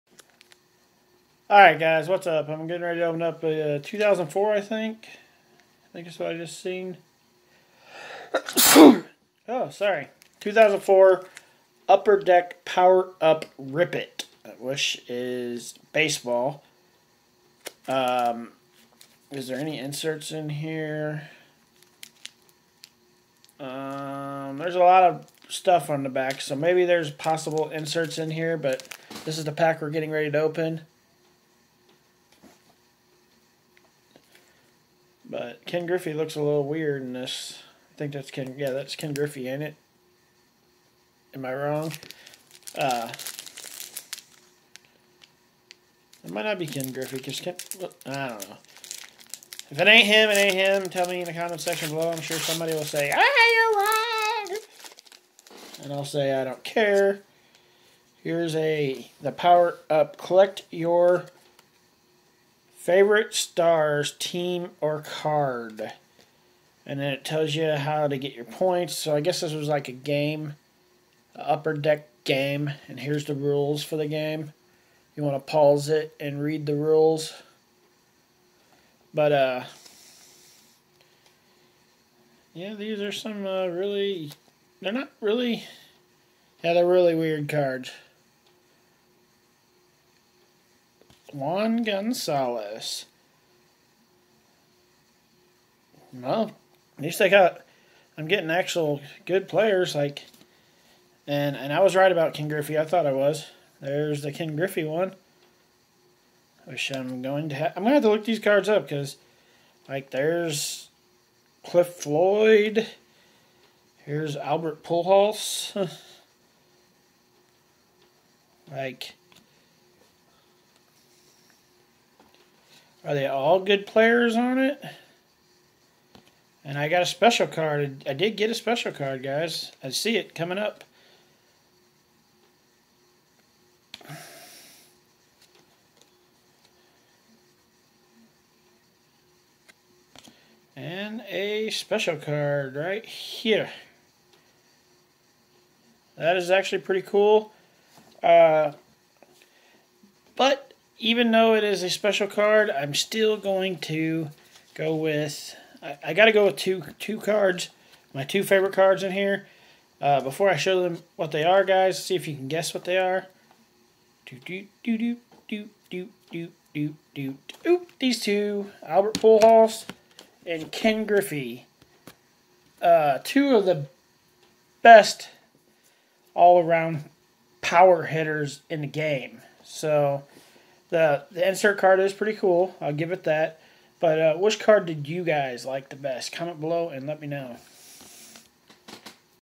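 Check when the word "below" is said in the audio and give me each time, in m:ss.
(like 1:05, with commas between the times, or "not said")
0:51, 3:06.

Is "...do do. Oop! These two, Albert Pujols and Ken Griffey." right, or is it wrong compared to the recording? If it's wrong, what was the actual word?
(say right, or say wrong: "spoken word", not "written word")
right.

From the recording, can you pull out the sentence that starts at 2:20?
And a special card right here.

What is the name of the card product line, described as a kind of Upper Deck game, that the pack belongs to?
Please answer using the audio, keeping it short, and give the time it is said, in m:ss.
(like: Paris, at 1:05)
Power Up Rip It, at 0:12.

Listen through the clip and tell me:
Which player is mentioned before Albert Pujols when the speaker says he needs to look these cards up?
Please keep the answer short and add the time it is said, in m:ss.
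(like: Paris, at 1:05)
Cliff Floyd, at 1:51.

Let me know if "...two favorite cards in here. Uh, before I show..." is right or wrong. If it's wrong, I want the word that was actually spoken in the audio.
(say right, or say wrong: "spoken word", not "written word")
right.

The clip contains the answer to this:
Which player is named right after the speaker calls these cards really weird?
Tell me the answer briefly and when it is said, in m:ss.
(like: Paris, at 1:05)
Juan Gonzalez, at 1:31.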